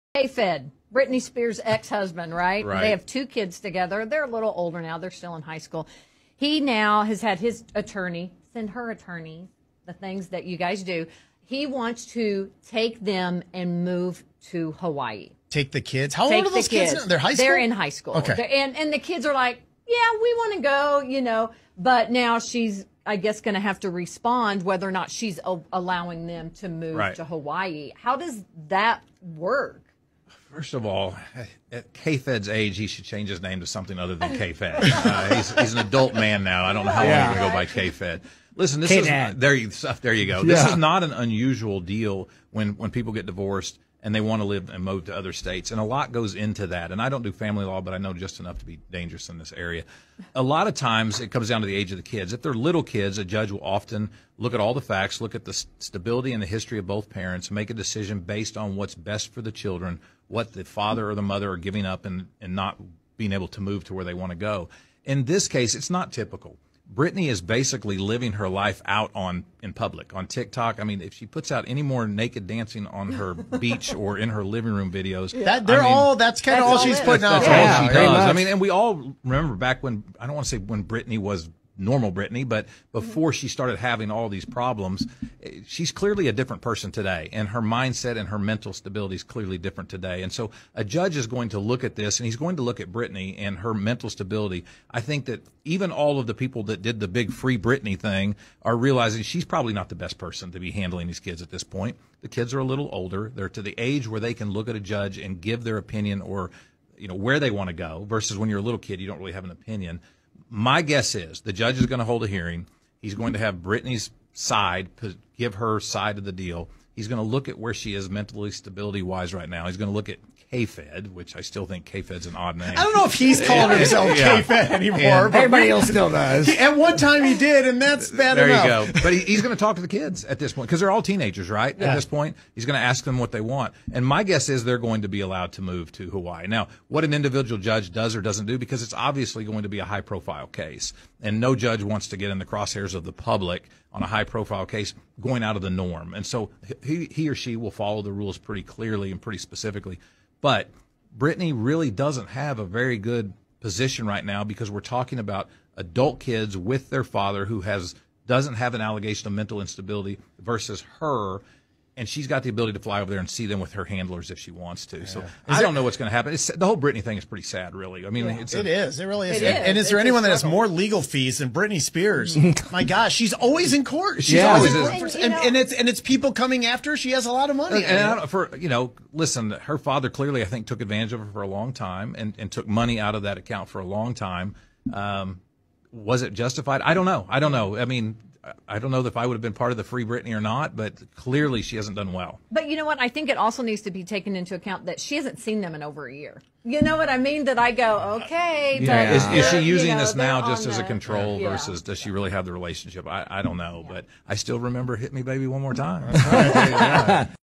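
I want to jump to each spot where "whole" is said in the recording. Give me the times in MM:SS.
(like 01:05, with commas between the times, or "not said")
02:46.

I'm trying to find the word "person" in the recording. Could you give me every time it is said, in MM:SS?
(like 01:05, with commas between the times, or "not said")
01:26, 01:40.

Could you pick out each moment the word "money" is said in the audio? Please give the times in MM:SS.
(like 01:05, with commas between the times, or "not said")
02:57, 03:02.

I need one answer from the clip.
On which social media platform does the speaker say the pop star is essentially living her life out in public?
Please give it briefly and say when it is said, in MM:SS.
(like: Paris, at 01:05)
TikTok, at 01:10.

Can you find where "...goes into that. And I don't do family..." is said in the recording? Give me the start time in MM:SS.
00:46.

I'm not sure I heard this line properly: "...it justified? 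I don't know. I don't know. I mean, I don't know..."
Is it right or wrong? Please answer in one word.
right.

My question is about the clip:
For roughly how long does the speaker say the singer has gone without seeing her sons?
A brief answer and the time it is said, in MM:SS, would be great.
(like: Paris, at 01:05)
over a year, at 03:15.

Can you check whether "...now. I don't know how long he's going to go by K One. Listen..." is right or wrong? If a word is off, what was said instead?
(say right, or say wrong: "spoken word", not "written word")
wrong: "Fed", not "One".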